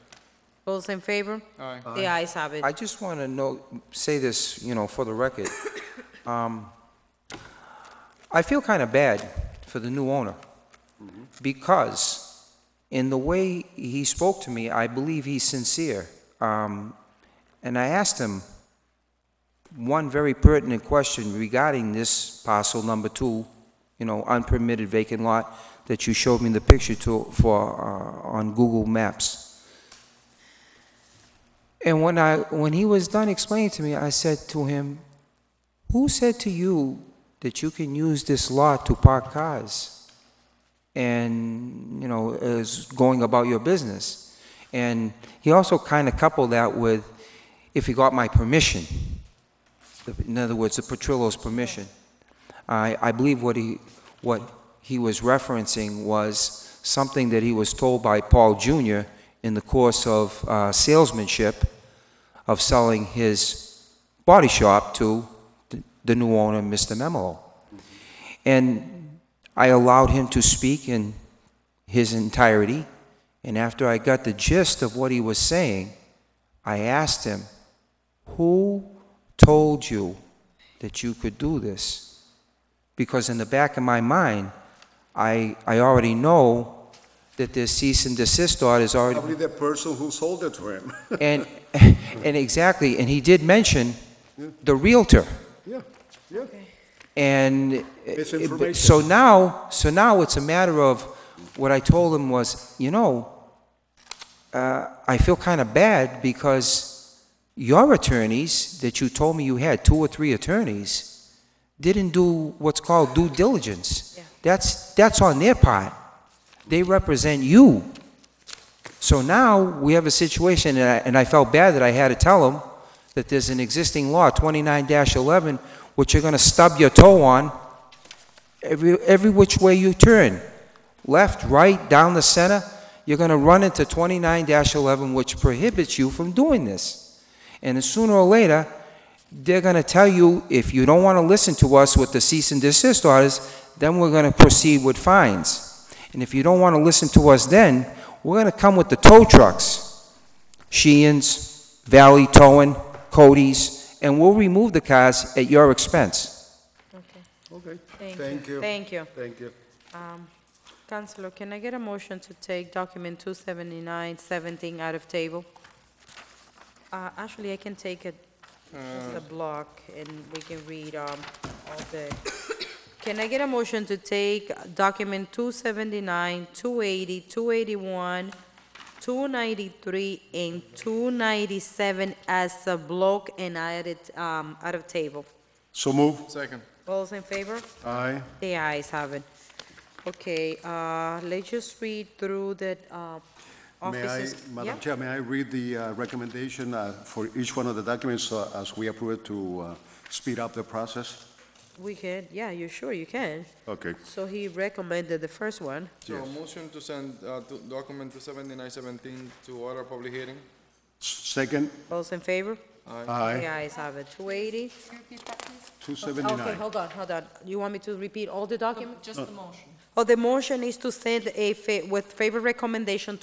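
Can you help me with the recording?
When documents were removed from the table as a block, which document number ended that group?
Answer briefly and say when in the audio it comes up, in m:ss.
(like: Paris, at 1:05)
297, at 3:00.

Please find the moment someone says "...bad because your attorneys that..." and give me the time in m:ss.
1:45.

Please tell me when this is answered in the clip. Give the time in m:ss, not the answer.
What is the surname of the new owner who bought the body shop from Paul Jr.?
1:06.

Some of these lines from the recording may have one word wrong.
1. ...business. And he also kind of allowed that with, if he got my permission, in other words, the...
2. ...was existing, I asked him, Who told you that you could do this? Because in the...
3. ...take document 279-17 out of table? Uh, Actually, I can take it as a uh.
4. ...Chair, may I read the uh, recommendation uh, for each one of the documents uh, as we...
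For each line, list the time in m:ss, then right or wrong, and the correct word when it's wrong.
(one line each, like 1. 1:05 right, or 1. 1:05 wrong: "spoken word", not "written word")
1. 0:43 wrong: "coupled", not "allowed"
2. 1:15 wrong: "saying", not "existing"
3. 2:42 right
4. 3:14 right.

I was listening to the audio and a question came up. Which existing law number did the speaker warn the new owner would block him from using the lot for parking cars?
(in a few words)
29-11.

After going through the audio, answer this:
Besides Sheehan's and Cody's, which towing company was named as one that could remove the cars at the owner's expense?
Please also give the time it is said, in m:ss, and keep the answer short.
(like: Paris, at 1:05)
Valley Towing, at 2:31.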